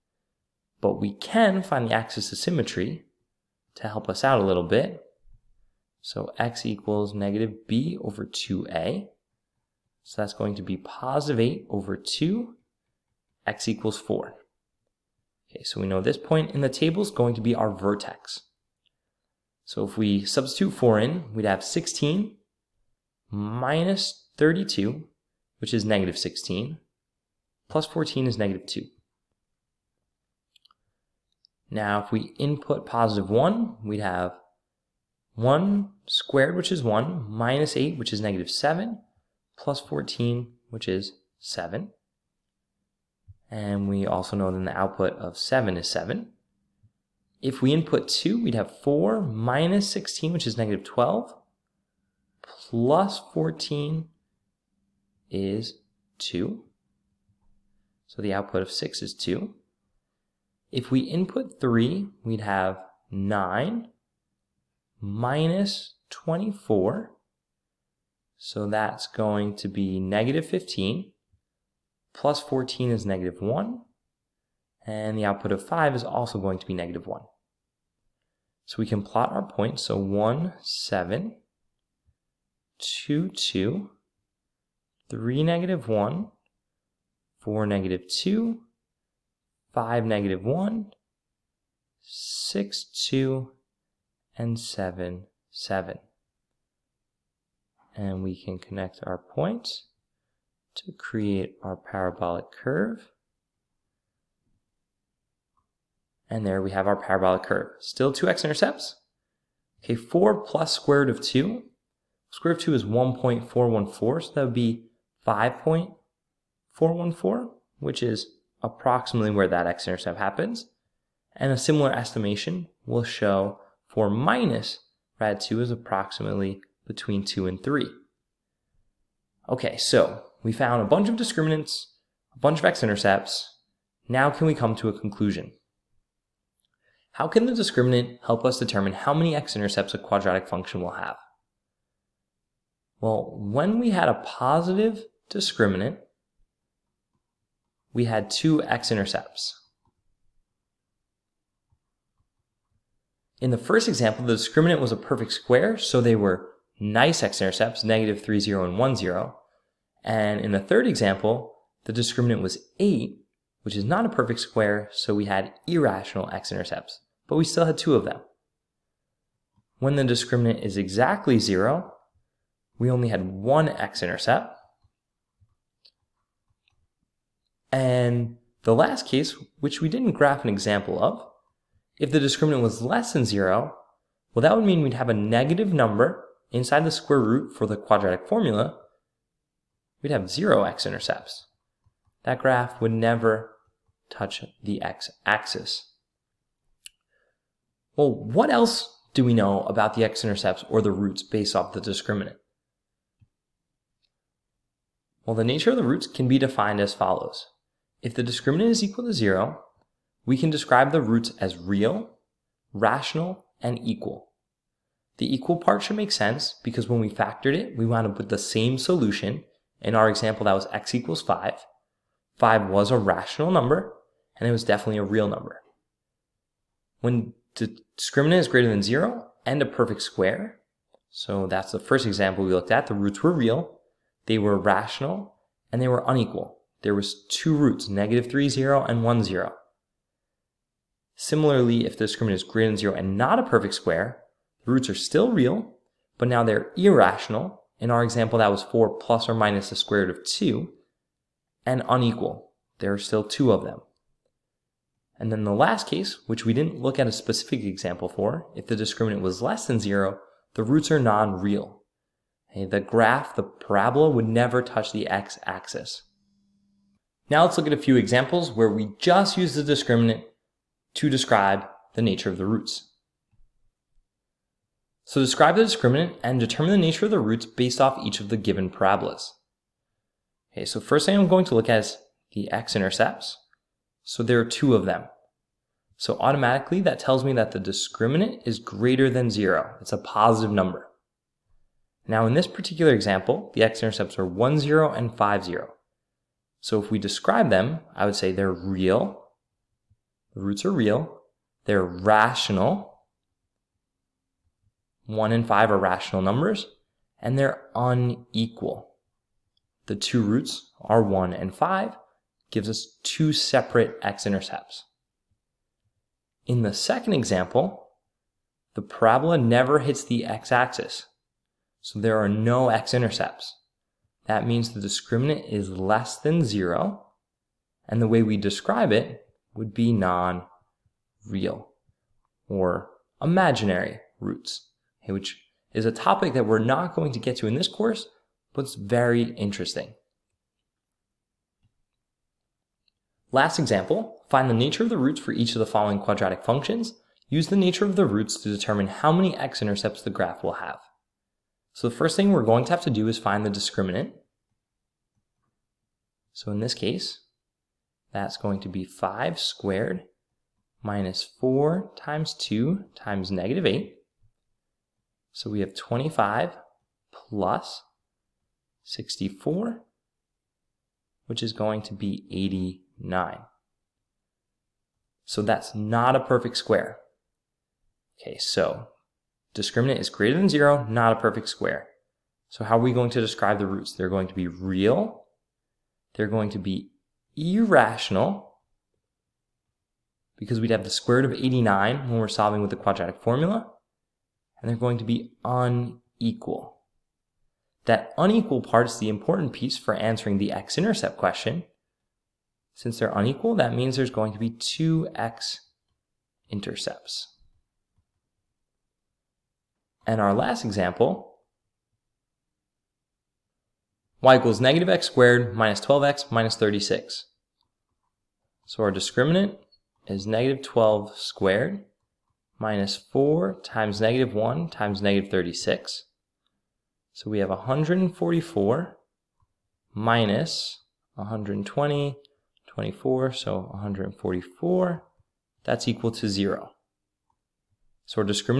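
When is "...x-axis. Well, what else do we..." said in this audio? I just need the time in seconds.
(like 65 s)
194 s.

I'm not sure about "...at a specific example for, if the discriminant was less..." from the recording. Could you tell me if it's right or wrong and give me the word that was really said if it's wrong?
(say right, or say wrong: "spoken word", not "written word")
right.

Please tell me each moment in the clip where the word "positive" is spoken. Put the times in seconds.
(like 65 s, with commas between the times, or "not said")
10 s, 32 s, 144 s, 289 s.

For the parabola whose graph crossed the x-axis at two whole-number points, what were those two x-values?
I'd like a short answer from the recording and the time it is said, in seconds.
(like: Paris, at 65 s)
1 and 5, at 294 s.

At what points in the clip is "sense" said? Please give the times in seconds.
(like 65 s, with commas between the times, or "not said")
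216 s.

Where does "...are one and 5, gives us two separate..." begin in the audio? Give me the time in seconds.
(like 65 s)
310 s.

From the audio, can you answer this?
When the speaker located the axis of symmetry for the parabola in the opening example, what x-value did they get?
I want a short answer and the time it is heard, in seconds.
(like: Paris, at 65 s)
x = 4, at 13 s.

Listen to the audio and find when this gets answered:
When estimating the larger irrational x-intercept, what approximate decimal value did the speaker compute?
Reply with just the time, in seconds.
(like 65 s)
115 s.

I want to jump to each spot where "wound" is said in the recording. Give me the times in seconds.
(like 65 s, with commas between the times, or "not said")
217 s.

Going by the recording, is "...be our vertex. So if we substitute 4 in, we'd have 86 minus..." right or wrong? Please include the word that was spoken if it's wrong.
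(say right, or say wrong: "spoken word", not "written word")
wrong: "16", not "86".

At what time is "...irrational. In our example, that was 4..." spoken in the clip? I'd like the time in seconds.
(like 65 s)
246 s.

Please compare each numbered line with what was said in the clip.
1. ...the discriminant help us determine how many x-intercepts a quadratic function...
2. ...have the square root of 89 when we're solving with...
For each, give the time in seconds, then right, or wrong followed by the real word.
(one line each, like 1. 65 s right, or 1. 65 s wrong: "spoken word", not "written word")
1. 137 s right
2. 390 s right.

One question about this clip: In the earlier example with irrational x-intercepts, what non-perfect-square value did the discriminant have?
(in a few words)
8.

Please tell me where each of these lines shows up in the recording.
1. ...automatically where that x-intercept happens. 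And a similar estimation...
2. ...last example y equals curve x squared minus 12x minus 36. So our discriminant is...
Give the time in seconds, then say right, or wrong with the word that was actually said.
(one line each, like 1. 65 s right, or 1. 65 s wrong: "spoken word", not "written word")
1. 118 s wrong: "approximately", not "automatically"
2. 410 s wrong: "negative", not "curve".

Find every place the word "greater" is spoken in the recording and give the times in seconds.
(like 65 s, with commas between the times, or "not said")
228 s, 242 s, 288 s, 380 s.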